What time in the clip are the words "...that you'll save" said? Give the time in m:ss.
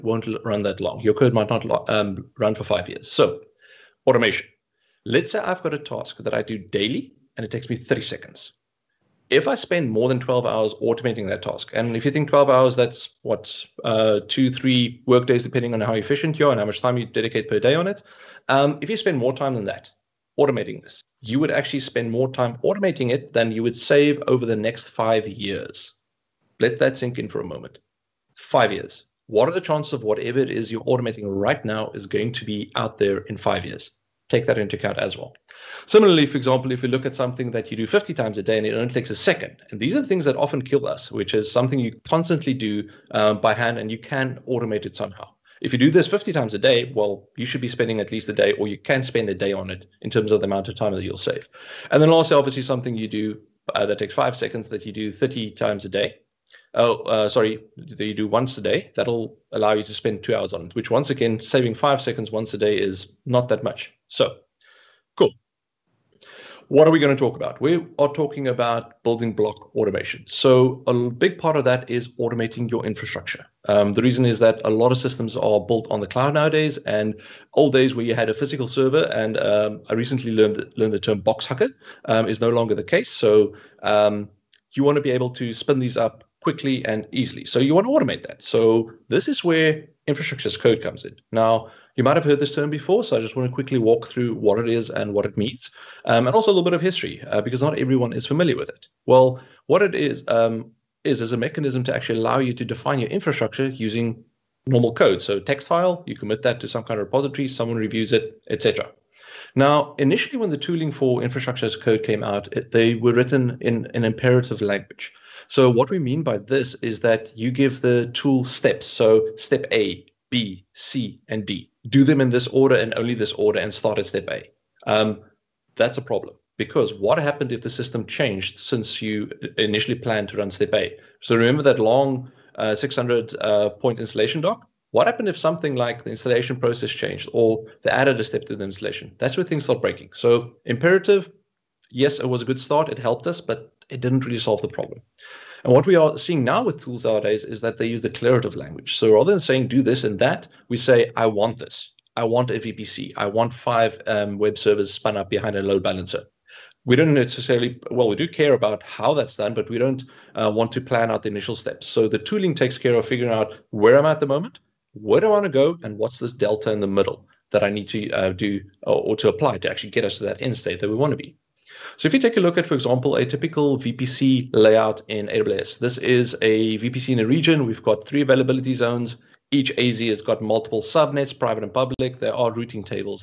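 0:50.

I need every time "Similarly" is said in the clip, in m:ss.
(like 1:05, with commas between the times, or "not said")
0:35.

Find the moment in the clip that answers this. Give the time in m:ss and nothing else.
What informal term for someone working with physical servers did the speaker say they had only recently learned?
1:21.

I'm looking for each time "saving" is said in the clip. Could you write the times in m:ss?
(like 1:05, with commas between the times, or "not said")
1:01.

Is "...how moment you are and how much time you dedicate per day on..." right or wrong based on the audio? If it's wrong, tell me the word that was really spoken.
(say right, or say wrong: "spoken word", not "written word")
wrong: "efficient", not "moment".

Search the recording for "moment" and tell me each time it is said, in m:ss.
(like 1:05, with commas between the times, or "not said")
0:27, 2:44.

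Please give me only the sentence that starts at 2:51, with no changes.
So if you take a look at, for example, a typical VPC layout in AWS, this is a VPC in a region.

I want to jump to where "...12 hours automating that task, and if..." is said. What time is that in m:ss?
0:10.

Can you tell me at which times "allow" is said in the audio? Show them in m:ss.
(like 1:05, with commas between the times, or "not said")
0:59, 1:42.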